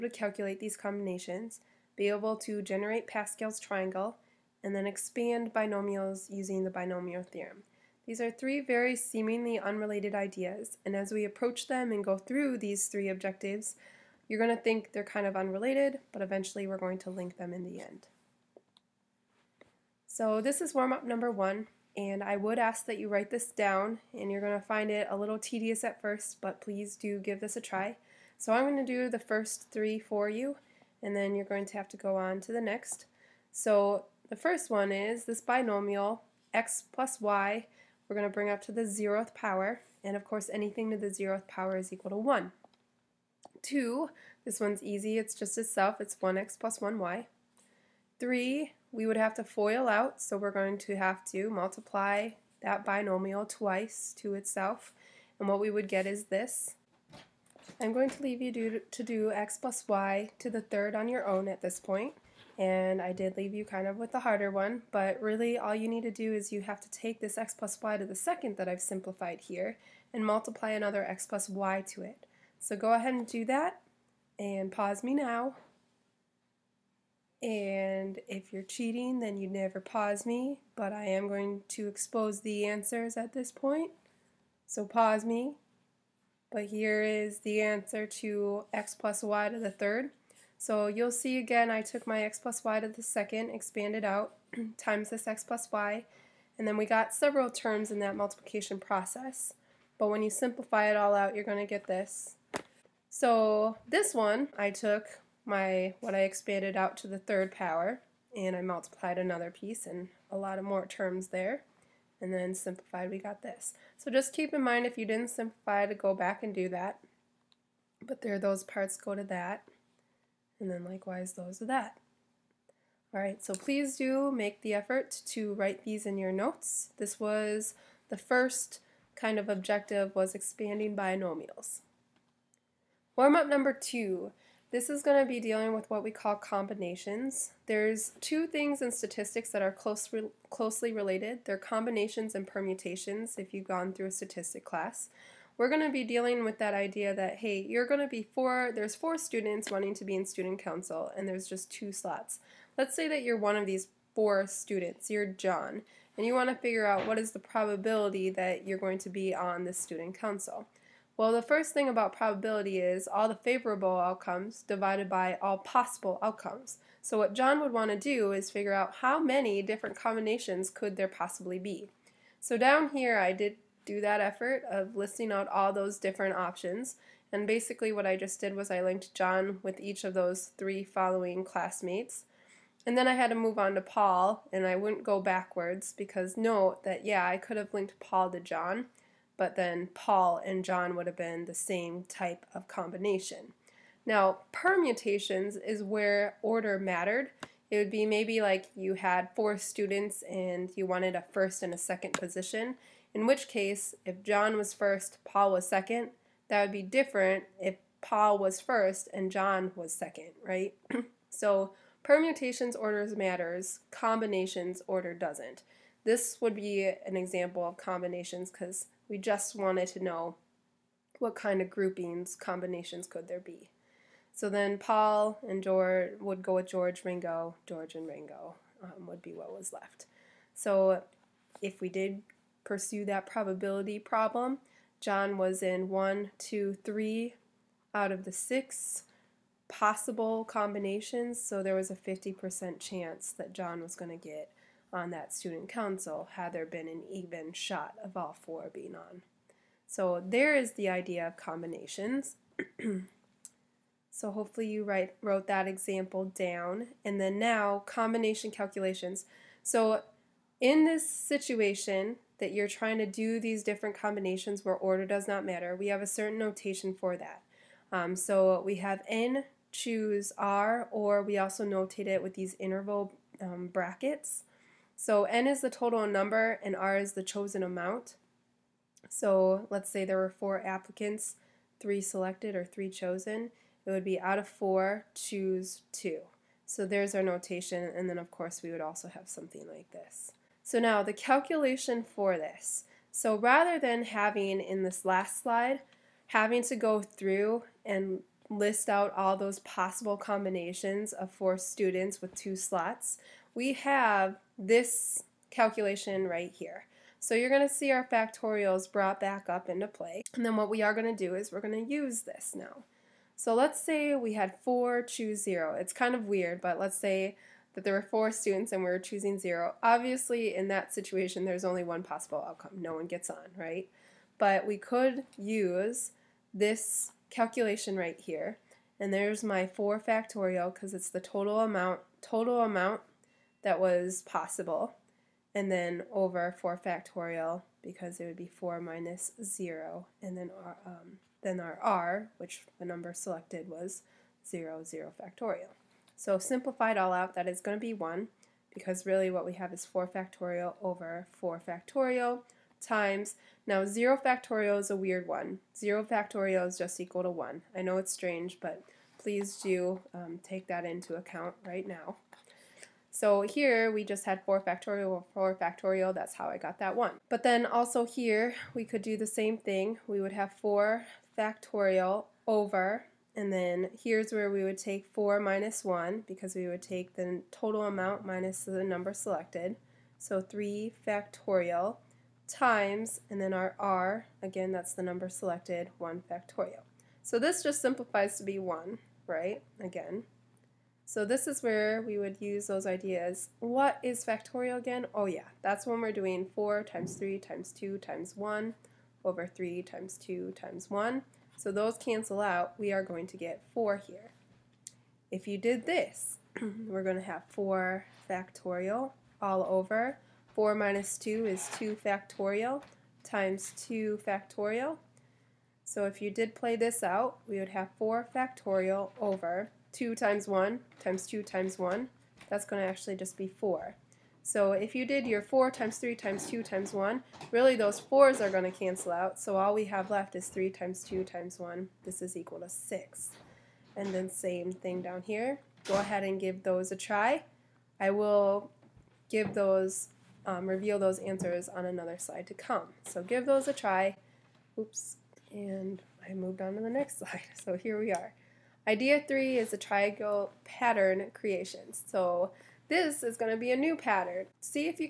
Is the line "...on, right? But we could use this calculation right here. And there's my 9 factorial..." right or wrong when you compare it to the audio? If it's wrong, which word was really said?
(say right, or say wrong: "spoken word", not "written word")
wrong: "4", not "9".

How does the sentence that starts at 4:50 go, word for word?
So now the calculation for this.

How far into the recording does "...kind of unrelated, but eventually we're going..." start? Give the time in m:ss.
0:15.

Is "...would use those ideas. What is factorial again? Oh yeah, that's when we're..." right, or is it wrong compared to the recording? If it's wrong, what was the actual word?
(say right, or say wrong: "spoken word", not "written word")
right.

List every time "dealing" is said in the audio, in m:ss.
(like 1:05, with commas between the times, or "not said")
2:15, 2:26.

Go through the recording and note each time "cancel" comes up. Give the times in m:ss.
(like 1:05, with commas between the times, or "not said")
6:41, 7:08.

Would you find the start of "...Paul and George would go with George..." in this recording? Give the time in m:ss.
3:44.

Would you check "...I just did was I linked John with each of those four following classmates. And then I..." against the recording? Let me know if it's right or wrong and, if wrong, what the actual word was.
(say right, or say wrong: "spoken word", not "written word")
wrong: "three", not "four".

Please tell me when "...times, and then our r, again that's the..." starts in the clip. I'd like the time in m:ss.
6:22.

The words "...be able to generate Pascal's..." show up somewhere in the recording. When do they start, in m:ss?
0:01.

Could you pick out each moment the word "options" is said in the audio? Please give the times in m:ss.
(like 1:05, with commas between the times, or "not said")
2:56.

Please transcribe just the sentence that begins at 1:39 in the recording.
But when you simplify it all out, you're going to get this.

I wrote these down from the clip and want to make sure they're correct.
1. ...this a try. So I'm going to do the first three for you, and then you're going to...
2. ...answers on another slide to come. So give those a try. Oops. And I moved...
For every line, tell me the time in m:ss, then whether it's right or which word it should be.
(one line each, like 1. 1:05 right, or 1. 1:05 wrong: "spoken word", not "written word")
1. 0:27 right
2. 7:21 right.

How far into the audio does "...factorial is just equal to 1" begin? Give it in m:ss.
5:56.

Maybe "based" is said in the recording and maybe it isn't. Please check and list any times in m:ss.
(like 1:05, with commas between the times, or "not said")
not said.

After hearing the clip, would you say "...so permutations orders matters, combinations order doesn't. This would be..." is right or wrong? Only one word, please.
right.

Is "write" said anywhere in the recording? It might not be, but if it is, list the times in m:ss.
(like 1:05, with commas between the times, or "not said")
0:23, 2:05, 4:14.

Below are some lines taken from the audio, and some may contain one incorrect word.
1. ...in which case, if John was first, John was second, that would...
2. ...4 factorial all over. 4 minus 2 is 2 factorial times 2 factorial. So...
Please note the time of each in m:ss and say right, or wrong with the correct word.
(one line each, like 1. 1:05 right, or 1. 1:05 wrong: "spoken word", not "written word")
1. 3:23 wrong: "Paul", not "John"
2. 6:47 right.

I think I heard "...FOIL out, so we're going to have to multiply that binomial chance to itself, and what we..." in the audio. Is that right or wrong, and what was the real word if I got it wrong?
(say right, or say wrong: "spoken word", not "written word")
wrong: "twice", not "chance".